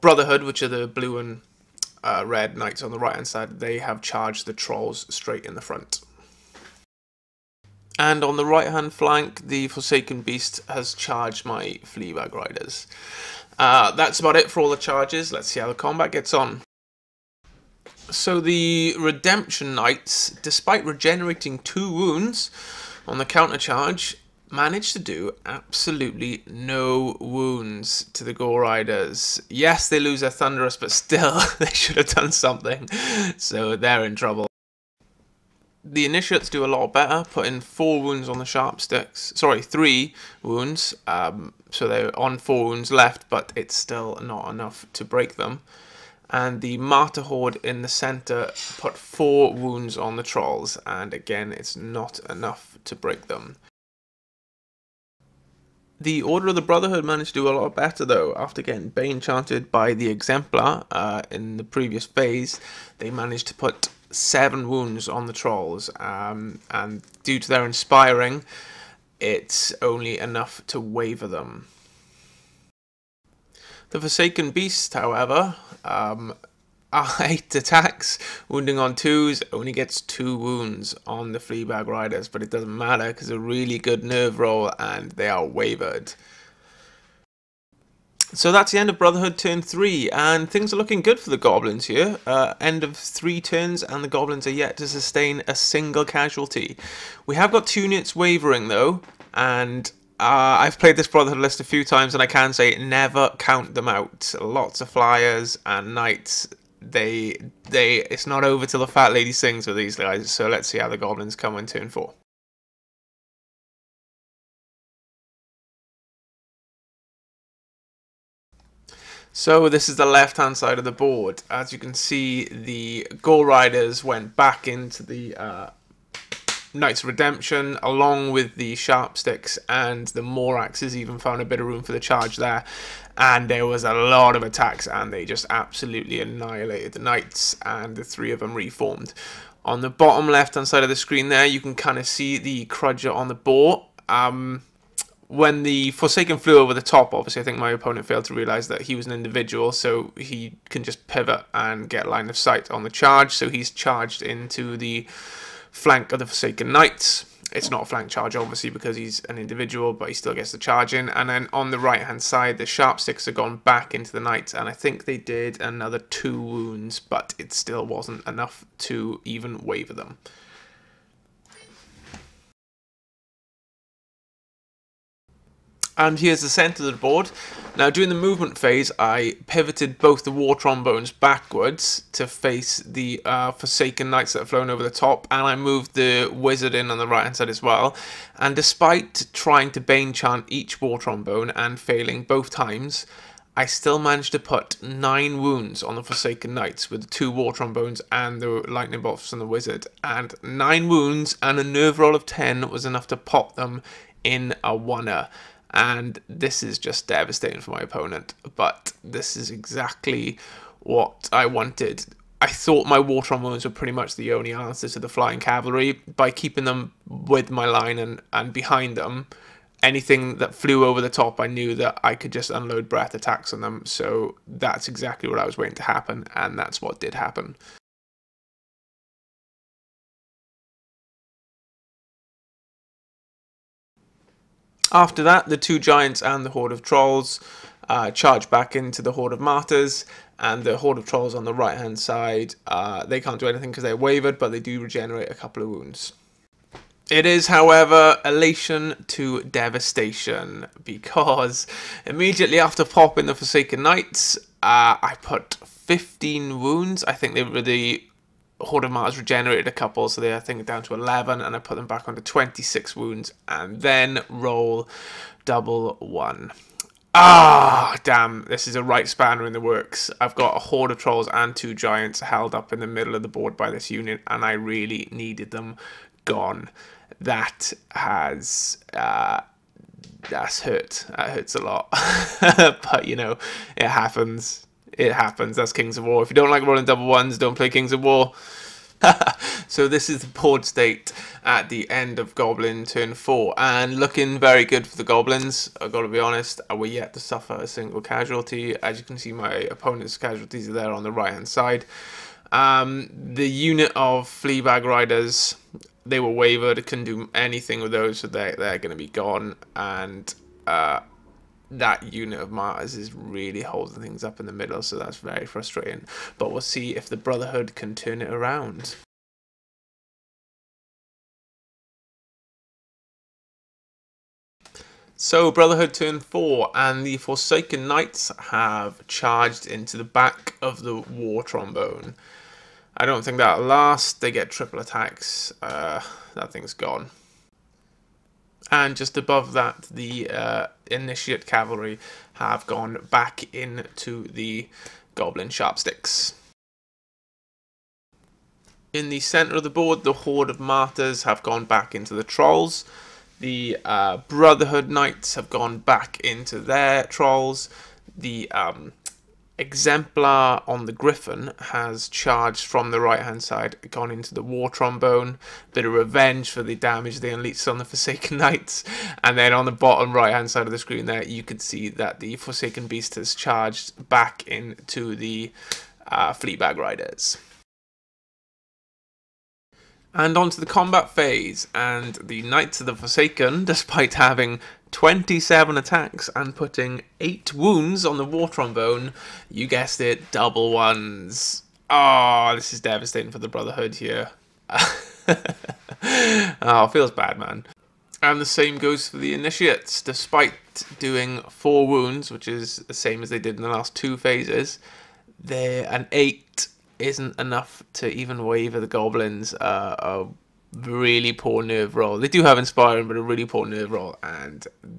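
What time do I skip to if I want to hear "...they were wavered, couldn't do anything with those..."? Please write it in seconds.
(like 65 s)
306 s.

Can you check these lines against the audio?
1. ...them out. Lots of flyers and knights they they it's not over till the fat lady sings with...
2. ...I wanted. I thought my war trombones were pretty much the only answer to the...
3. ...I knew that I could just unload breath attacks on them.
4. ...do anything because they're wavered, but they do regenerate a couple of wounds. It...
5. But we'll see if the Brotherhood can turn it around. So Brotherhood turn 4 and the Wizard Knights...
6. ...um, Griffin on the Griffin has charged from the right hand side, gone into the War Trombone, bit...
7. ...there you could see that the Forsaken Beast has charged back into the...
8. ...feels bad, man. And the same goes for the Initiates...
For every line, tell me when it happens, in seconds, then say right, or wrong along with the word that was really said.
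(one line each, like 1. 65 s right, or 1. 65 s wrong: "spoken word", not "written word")
1. 103 s right
2. 211 s right
3. 221 s right
4. 243 s right
5. 316 s wrong: "Forsaken", not "Wizard"
6. 358 s wrong: "Exemplar", not "Griffin"
7. 371 s right
8. 396 s right.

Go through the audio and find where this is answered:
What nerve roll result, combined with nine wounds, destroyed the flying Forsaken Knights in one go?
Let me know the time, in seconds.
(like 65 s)
202 s.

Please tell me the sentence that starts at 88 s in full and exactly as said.
So that's the end of Brotherhood turn 3, and things are looking good for the Goblins here.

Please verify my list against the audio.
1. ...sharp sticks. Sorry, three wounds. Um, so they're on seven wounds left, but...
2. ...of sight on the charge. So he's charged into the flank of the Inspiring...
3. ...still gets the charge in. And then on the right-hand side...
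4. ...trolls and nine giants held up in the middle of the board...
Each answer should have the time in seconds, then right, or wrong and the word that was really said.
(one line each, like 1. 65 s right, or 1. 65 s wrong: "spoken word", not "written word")
1. 38 s wrong: "four", not "seven"
2. 152 s wrong: "Forsaken", not "Inspiring"
3. 160 s right
4. 270 s wrong: "two", not "nine".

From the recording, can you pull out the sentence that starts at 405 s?
They're an 8 isn't enough to even waver the Goblins.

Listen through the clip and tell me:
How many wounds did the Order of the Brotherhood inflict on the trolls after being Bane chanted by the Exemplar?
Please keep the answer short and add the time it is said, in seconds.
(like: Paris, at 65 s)
7, at 64 s.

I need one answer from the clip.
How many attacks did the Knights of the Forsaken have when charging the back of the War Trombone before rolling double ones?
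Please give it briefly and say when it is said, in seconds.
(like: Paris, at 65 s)
27, at 384 s.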